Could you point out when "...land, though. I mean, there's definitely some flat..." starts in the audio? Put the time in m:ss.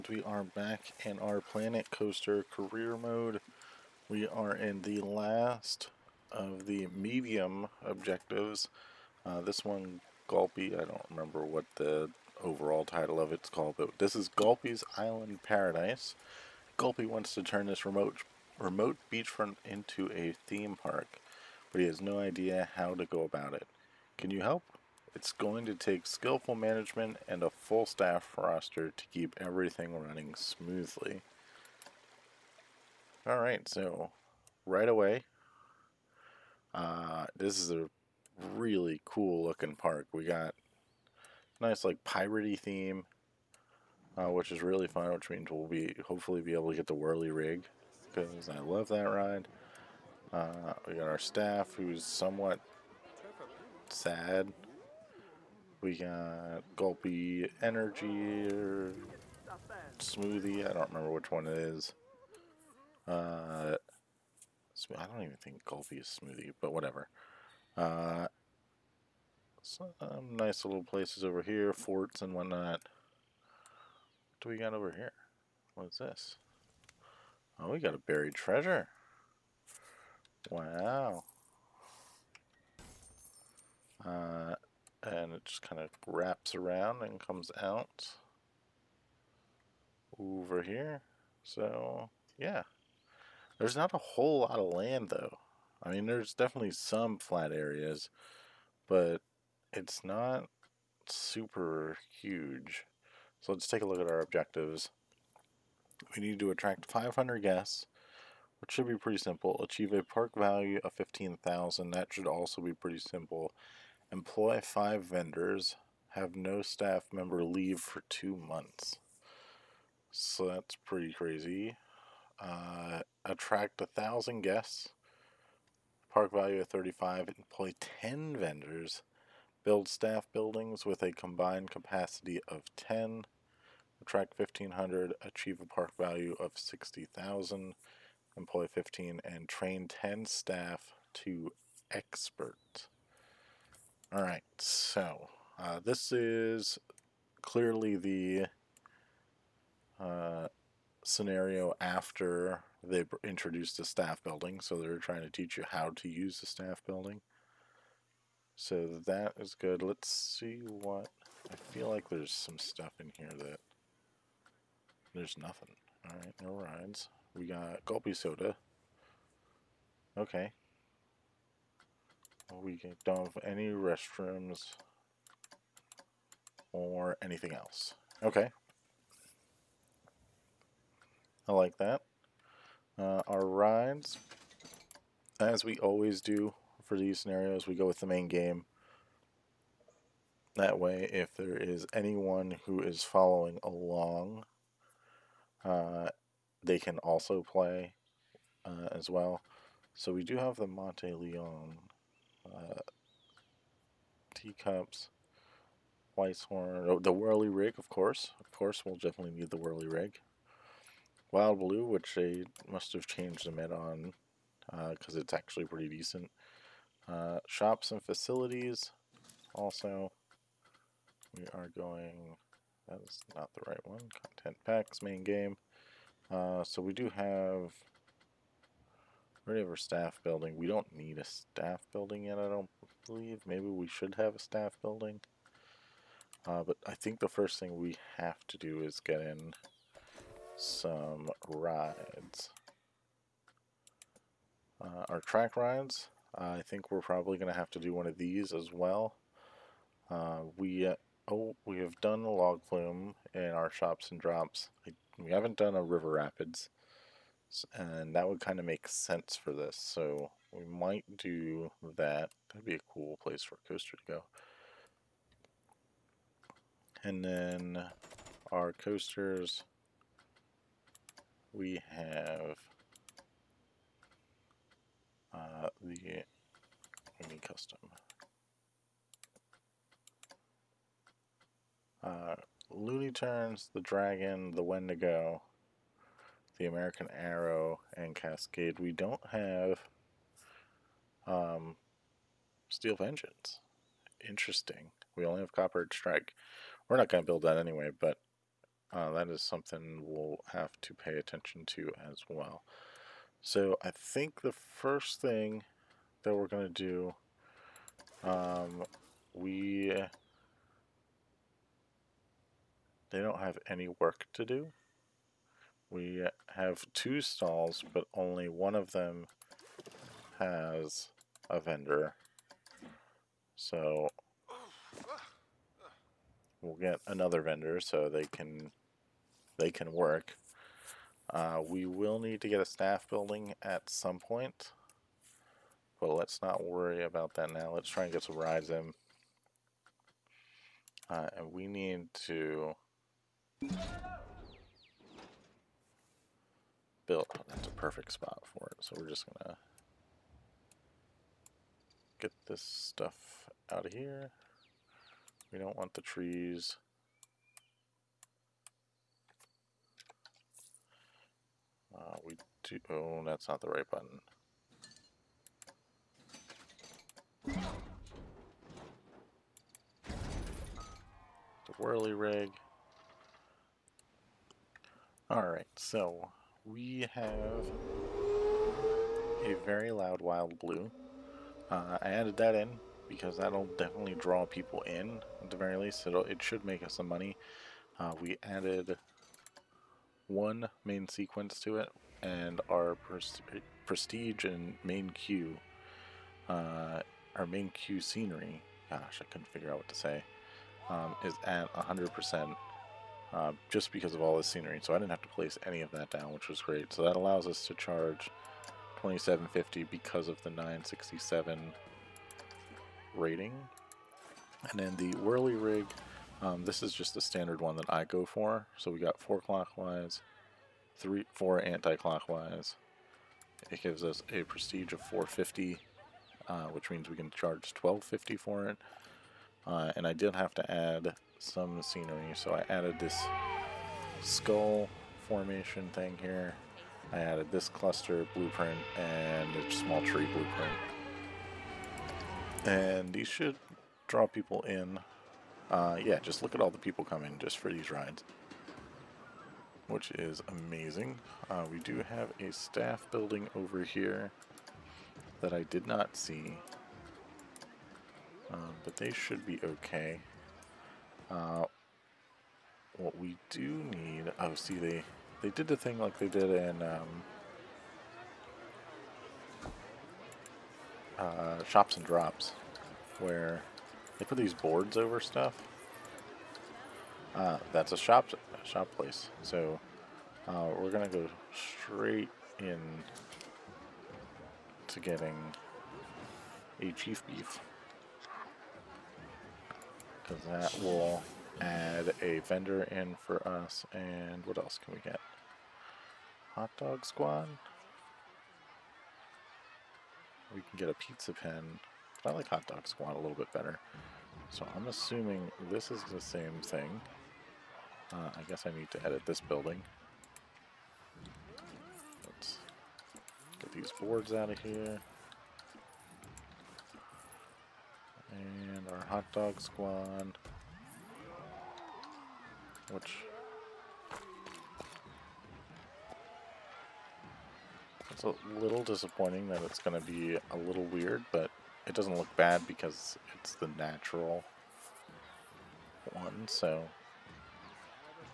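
1:34.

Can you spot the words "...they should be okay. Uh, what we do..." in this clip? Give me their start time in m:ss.
7:38.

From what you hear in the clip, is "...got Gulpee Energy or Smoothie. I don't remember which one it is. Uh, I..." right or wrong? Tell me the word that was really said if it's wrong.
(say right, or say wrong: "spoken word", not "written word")
right.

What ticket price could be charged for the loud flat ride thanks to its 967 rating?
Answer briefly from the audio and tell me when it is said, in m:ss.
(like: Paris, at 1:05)
2750, at 6:49.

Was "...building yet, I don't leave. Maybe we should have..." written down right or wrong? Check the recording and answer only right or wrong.
wrong.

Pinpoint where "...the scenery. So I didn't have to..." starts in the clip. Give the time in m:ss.
6:44.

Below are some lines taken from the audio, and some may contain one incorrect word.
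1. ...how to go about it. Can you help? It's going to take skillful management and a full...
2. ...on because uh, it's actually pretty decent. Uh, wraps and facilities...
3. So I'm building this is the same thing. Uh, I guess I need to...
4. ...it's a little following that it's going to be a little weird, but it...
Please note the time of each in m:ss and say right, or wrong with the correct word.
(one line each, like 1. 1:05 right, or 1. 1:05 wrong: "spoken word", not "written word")
1. 0:22 right
2. 3:33 wrong: "shops", not "wraps"
3. 8:24 wrong: "assuming", not "building"
4. 8:48 wrong: "disappointing", not "following".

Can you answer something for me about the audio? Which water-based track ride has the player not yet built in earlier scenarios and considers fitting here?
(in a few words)
river rapids.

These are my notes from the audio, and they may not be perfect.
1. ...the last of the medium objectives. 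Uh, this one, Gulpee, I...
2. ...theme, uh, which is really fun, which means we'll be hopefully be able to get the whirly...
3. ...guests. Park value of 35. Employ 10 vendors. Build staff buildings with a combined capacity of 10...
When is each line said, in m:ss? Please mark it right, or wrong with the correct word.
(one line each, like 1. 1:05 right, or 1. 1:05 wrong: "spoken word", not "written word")
1. 0:04 right
2. 0:42 right
3. 2:04 right.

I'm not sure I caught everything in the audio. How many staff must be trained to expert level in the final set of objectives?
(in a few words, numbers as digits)
10.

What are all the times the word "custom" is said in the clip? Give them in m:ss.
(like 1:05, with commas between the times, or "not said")
4:37.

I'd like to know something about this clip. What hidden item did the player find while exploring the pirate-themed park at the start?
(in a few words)
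buried treasure.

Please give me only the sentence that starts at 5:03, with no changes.
So I think the first thing that we're going to do, um, we they don't have any work to do.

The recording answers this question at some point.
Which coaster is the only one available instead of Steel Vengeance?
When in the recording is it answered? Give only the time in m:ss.
4:55.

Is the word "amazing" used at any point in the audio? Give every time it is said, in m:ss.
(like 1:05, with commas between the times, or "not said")
7:30.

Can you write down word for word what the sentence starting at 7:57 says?
Uh, that's a shop, shop place.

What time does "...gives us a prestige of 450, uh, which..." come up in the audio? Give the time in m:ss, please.
7:03.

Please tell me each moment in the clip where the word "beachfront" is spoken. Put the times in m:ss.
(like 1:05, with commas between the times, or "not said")
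0:19.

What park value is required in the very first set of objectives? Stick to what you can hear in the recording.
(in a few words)
15,000.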